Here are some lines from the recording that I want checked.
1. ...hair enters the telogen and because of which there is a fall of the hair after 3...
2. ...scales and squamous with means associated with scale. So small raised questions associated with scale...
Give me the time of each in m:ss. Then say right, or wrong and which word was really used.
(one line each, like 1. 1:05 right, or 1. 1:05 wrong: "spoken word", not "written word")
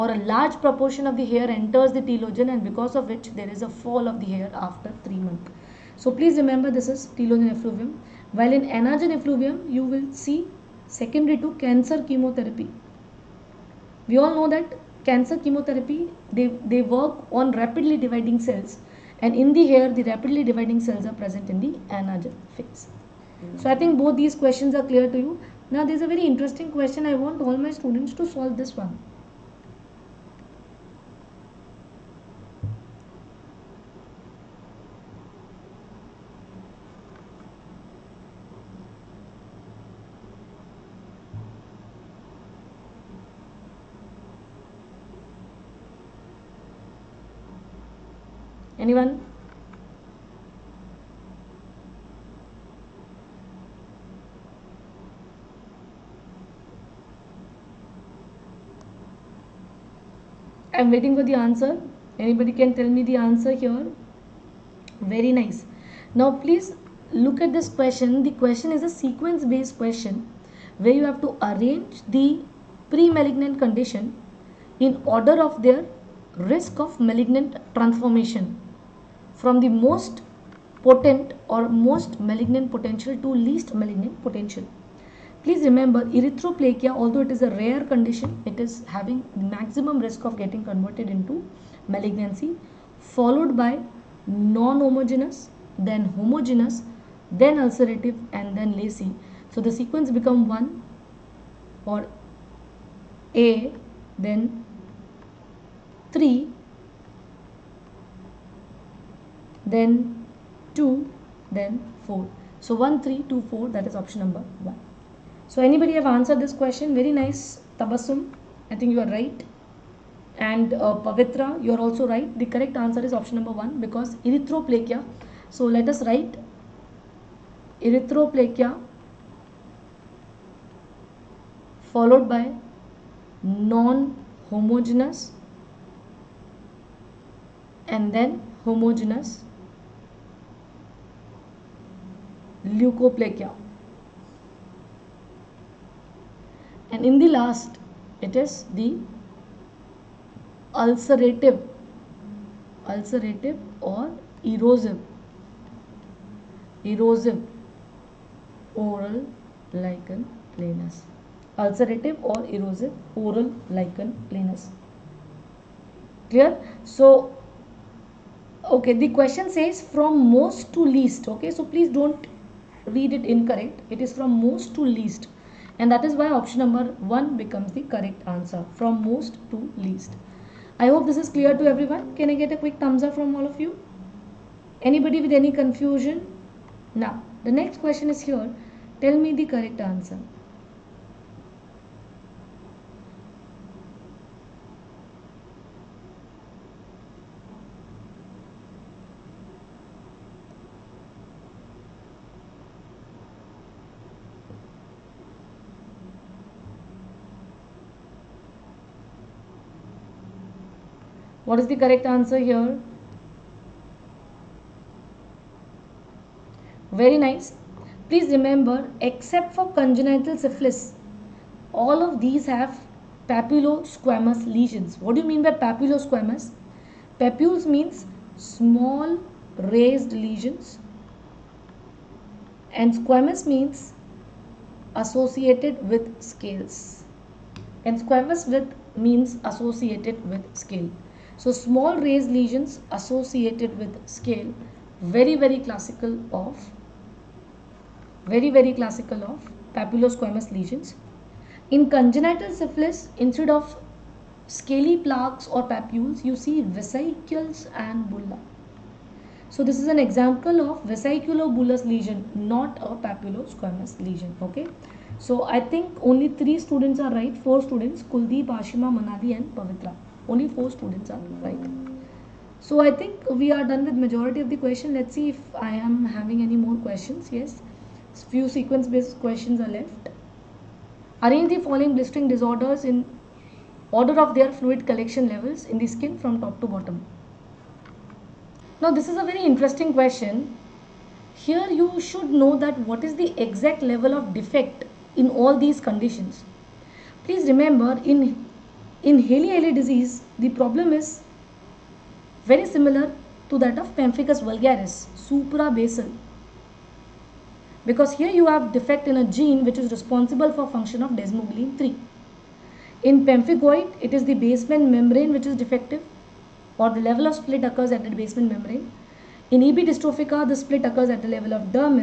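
1. 0:01 right
2. 3:56 wrong: "lesions", not "questions".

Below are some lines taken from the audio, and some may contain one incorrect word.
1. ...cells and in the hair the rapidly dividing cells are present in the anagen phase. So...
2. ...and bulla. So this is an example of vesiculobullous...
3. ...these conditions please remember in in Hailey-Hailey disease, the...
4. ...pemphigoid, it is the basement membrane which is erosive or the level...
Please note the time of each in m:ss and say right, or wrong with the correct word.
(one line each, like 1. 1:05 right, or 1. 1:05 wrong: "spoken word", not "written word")
1. 0:18 right
2. 4:17 right
3. 4:55 right
4. 5:13 wrong: "defective", not "erosive".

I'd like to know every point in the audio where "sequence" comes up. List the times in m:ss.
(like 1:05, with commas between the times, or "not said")
1:08, 1:39, 4:38.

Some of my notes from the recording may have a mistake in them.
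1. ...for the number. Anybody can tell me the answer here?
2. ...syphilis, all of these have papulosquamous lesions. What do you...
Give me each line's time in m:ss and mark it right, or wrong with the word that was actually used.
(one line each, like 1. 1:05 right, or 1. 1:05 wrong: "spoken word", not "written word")
1. 1:01 wrong: "answer", not "number"
2. 3:40 right.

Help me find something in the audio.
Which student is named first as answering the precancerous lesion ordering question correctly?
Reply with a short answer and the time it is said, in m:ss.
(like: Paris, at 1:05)
Tabassum, at 1:57.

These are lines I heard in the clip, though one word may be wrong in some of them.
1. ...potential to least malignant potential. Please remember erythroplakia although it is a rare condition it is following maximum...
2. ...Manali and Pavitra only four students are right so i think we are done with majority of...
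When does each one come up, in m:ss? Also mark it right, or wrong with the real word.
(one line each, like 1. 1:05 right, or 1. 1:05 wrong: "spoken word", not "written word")
1. 1:22 wrong: "having", not "following"
2. 4:28 right.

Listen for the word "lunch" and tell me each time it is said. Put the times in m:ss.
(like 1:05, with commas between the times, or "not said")
not said.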